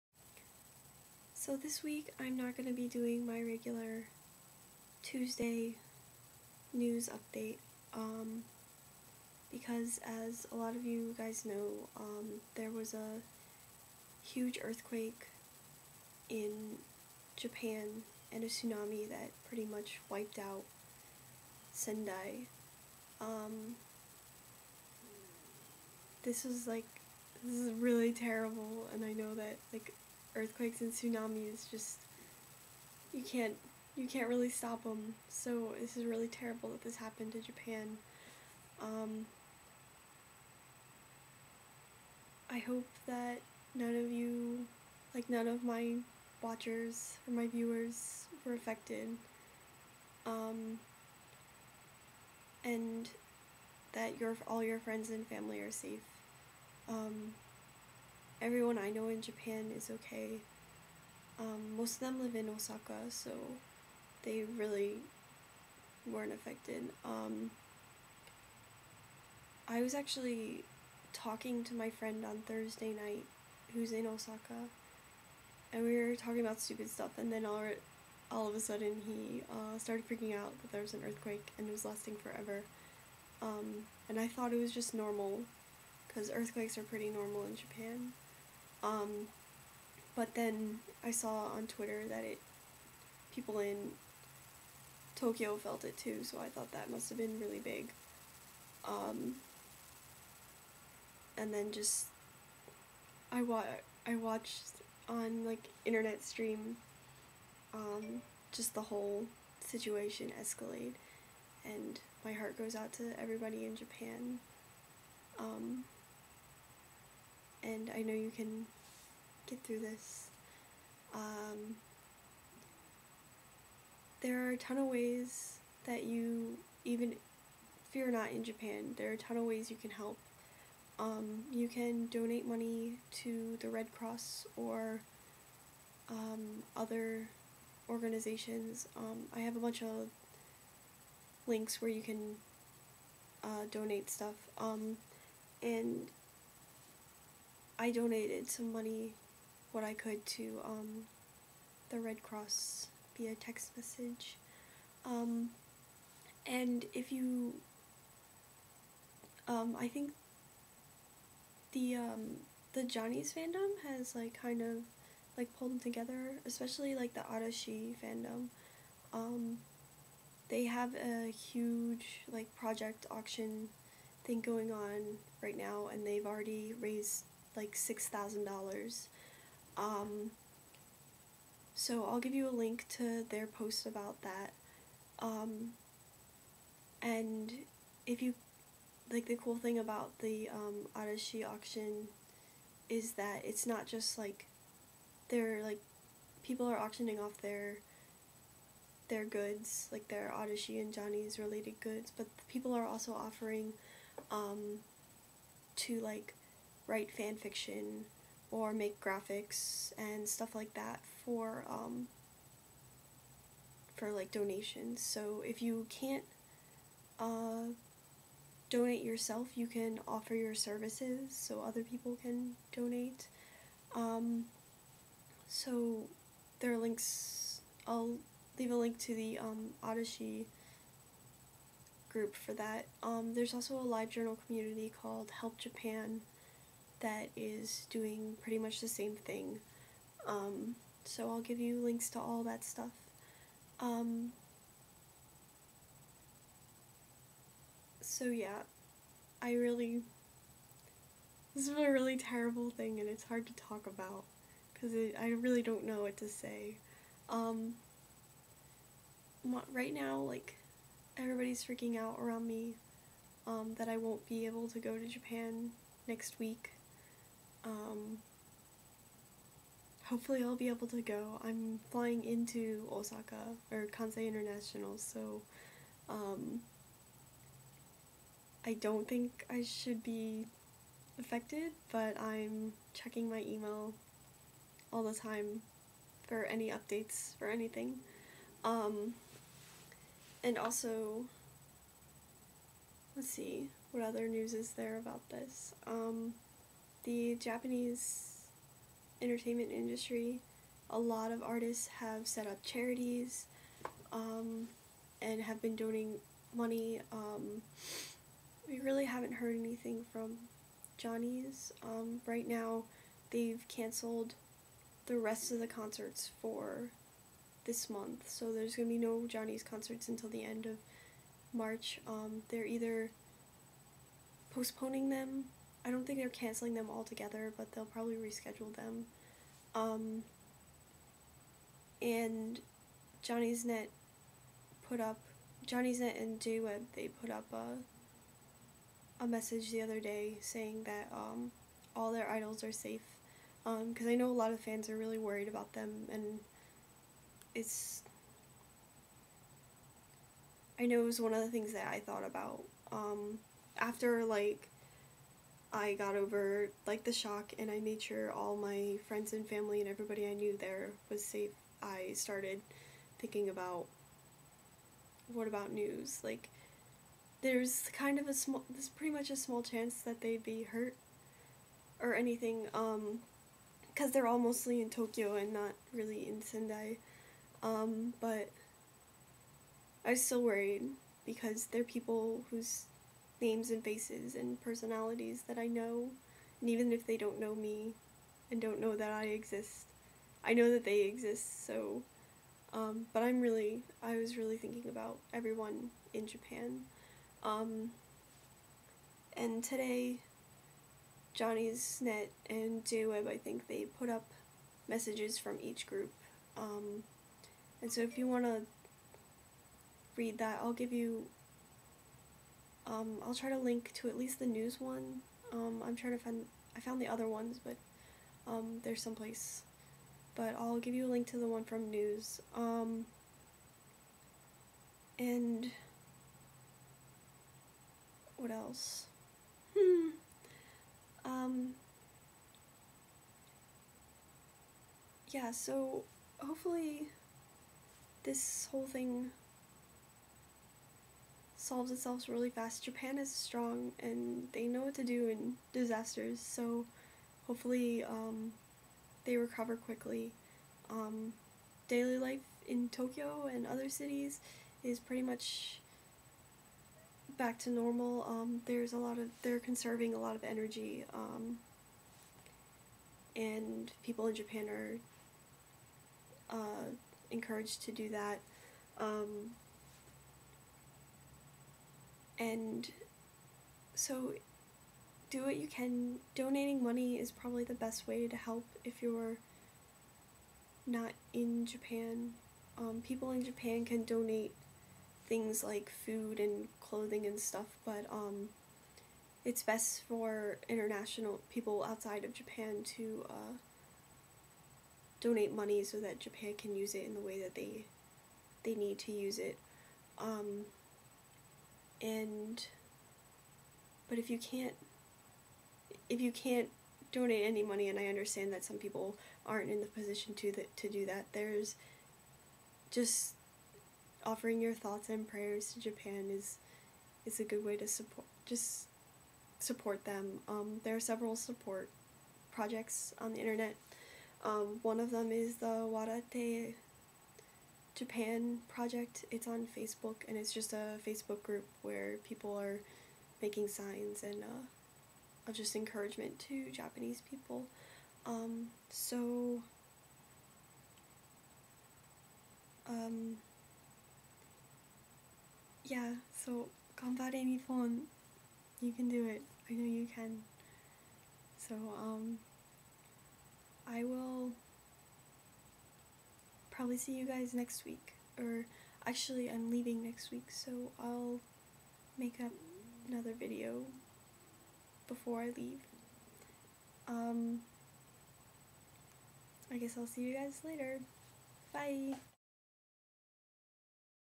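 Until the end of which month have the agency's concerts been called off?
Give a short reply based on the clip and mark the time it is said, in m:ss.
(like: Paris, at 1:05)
March, at 5:21.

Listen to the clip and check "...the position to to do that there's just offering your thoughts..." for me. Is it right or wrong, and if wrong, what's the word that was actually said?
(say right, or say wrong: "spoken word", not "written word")
right.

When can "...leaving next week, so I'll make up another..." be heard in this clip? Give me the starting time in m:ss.
9:19.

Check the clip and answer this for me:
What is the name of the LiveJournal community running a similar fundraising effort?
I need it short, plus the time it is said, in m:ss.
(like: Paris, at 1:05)
Help Japan, at 3:55.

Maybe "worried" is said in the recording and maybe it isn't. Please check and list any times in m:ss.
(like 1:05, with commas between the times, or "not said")
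5:45, 6:20.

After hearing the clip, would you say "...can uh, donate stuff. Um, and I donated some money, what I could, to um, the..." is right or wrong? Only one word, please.
right.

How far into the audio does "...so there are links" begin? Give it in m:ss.
3:45.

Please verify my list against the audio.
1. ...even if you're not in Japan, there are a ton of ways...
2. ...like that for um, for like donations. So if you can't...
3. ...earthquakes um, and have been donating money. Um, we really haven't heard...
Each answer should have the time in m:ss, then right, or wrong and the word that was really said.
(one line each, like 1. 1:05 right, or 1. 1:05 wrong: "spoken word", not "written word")
1. 2:06 right
2. 3:30 right
3. 5:02 wrong: "charities", not "earthquakes".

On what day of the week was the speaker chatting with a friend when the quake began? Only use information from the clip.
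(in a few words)
Thursday.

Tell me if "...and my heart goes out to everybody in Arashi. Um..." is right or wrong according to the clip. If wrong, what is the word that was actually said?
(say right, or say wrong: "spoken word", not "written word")
wrong: "Japan", not "Arashi".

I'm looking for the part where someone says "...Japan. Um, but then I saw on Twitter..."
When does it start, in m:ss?
1:27.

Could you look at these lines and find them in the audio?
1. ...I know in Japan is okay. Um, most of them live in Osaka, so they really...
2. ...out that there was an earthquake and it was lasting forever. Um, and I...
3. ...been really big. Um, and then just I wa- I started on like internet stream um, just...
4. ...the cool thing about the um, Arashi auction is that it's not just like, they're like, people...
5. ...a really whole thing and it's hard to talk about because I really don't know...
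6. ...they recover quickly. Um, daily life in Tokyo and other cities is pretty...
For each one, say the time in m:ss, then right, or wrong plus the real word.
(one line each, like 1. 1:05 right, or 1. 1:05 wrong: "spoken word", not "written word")
1. 0:58 right
2. 1:20 right
3. 1:37 wrong: "watched", not "started"
4. 3:09 right
5. 4:11 wrong: "terrible", not "whole"
6. 7:29 right.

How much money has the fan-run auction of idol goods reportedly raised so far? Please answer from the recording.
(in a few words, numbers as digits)
$6,000.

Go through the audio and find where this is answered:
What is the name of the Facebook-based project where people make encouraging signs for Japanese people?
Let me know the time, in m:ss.
8:45.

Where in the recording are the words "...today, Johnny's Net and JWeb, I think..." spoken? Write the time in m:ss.
6:39.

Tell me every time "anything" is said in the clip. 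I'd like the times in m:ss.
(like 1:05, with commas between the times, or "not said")
4:47, 5:09, 6:12.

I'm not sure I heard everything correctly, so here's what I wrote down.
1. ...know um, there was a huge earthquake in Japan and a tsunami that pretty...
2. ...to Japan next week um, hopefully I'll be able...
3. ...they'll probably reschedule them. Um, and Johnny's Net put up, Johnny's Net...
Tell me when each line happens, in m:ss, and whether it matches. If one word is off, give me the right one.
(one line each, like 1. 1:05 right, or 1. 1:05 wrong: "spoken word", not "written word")
1. 0:11 right
2. 4:24 right
3. 5:27 right.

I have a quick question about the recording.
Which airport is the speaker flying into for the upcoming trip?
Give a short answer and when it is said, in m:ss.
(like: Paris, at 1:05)
Kansai International, at 4:33.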